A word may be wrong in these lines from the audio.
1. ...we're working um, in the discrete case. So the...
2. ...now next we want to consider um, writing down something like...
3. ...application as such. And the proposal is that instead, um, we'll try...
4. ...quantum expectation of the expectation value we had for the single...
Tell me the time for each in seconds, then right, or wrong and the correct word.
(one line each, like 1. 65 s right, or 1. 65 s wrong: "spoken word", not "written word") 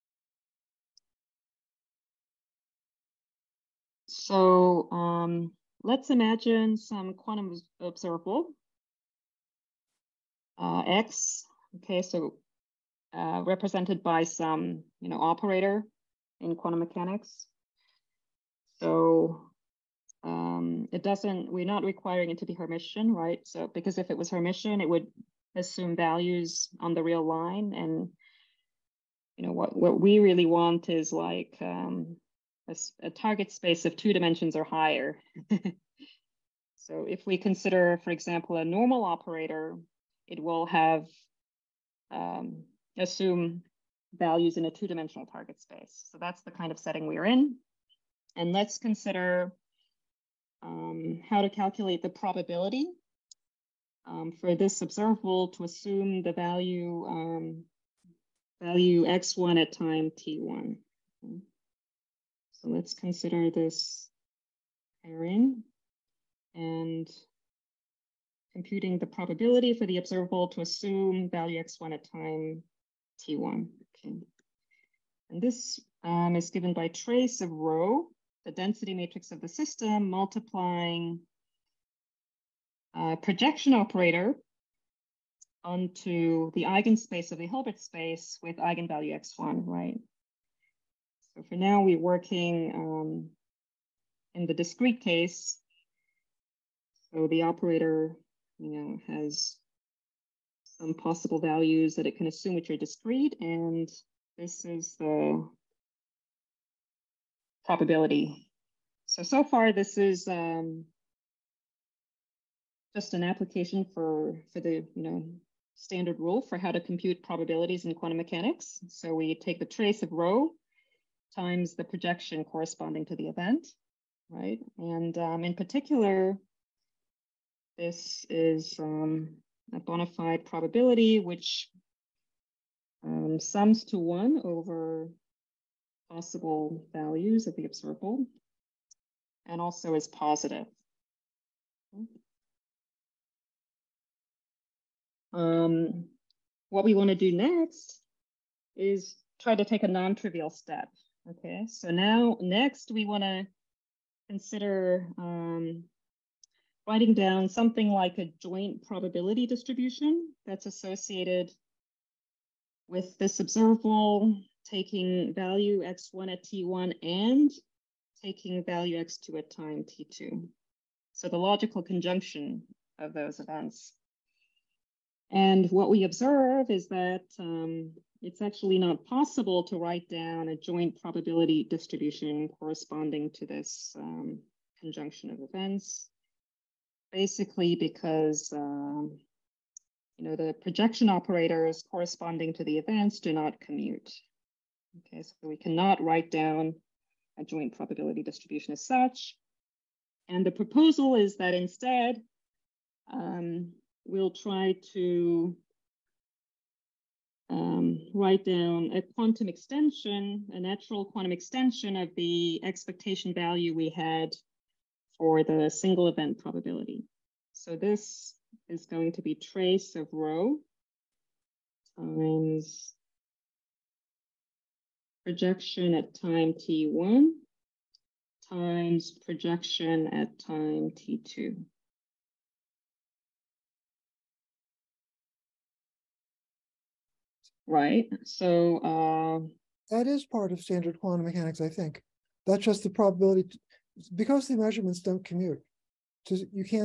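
1. 91 s right
2. 151 s right
3. 198 s wrong: "distribution", not "application"
4. 211 s wrong: "extension", not "expectation".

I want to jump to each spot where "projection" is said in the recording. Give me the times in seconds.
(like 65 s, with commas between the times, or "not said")
83 s, 121 s, 190 s, 225 s, 229 s.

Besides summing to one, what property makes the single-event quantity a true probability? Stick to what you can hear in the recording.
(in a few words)
Positive.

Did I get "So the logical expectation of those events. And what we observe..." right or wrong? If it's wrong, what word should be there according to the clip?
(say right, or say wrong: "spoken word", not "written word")
wrong: "conjunction", not "expectation".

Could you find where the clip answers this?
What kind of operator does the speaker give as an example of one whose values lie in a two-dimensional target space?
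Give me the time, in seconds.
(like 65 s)
38 s.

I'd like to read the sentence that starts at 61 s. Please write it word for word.
So let's consider this pairing and computing the probability for the observable to assume value x1 at time t1.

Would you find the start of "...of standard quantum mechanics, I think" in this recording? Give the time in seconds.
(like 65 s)
240 s.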